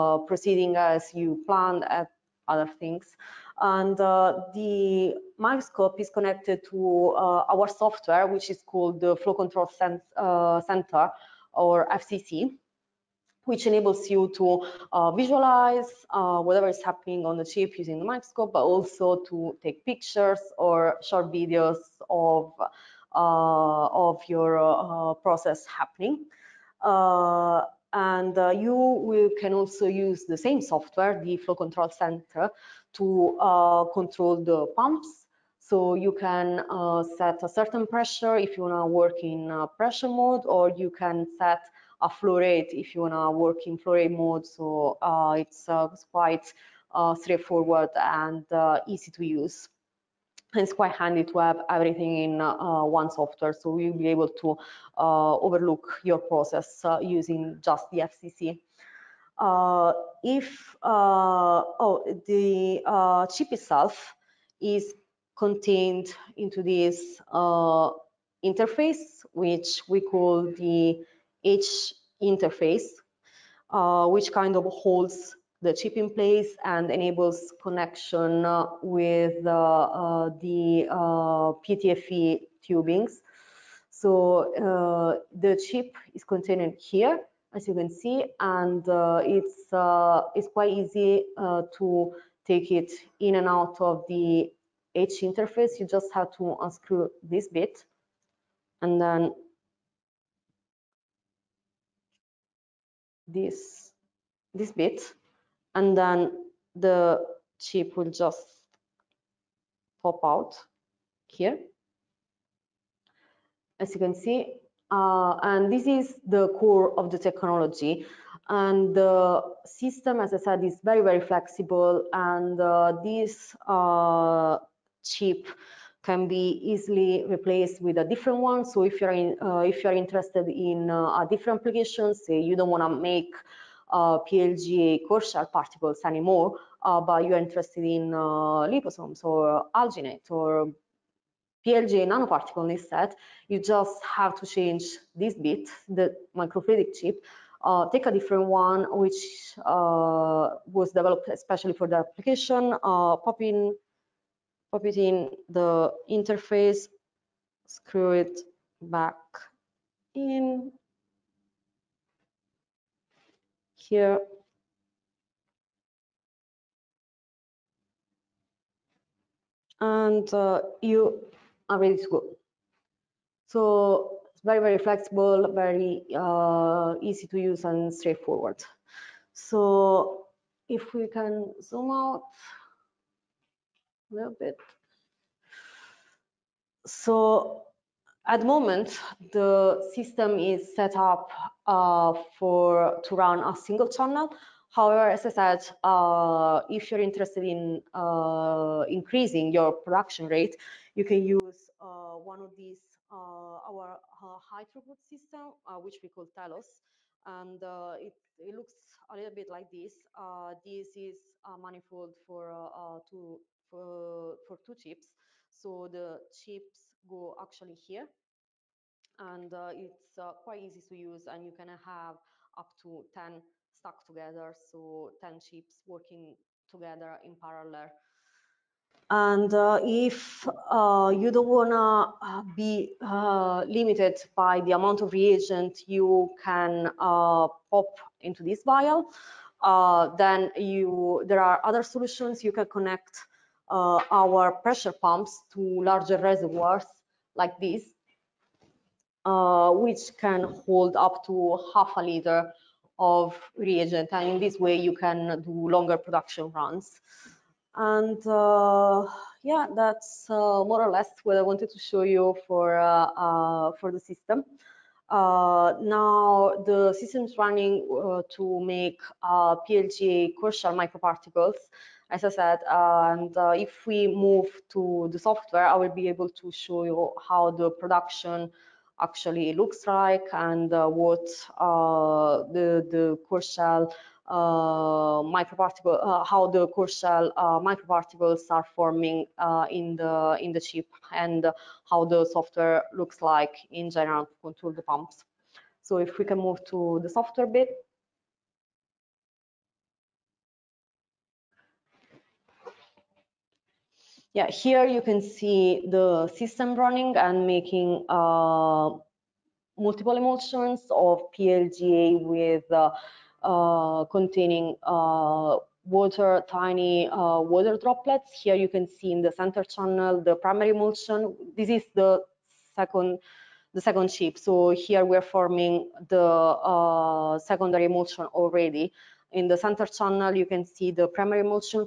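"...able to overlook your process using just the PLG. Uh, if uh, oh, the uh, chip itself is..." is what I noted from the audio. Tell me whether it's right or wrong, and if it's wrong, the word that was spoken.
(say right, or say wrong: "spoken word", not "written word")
wrong: "FCC", not "PLG".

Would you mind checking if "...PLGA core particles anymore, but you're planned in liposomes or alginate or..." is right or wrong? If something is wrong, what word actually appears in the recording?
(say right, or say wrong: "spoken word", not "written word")
wrong: "interested", not "planned".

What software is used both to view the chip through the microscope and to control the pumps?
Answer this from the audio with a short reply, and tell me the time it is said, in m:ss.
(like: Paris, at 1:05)
Flow Control Center, at 0:31.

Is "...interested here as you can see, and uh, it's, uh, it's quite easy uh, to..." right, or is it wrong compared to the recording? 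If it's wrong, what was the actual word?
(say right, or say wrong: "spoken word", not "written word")
wrong: "contained", not "interested".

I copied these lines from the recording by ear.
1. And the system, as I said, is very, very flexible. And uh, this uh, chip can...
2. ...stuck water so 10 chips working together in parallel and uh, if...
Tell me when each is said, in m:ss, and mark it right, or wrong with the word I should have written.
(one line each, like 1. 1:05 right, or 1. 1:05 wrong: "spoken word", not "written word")
1. 1:58 right
2. 3:43 wrong: "together", not "water".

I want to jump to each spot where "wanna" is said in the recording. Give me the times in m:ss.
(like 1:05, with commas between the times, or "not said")
0:38, 0:43.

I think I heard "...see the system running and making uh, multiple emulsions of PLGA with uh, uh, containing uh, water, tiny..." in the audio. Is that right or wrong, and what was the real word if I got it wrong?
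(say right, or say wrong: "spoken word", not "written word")
right.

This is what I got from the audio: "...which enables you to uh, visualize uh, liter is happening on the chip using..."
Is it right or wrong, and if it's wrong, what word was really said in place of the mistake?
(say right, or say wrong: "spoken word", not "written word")
wrong: "whatever", not "liter".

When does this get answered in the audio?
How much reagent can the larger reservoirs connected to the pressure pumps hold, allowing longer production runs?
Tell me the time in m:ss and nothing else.
4:11.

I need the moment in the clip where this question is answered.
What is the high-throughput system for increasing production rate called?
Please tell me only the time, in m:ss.
3:26.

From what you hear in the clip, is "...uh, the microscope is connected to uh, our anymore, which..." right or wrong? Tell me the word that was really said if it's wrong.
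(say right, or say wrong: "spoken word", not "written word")
wrong: "software", not "anymore".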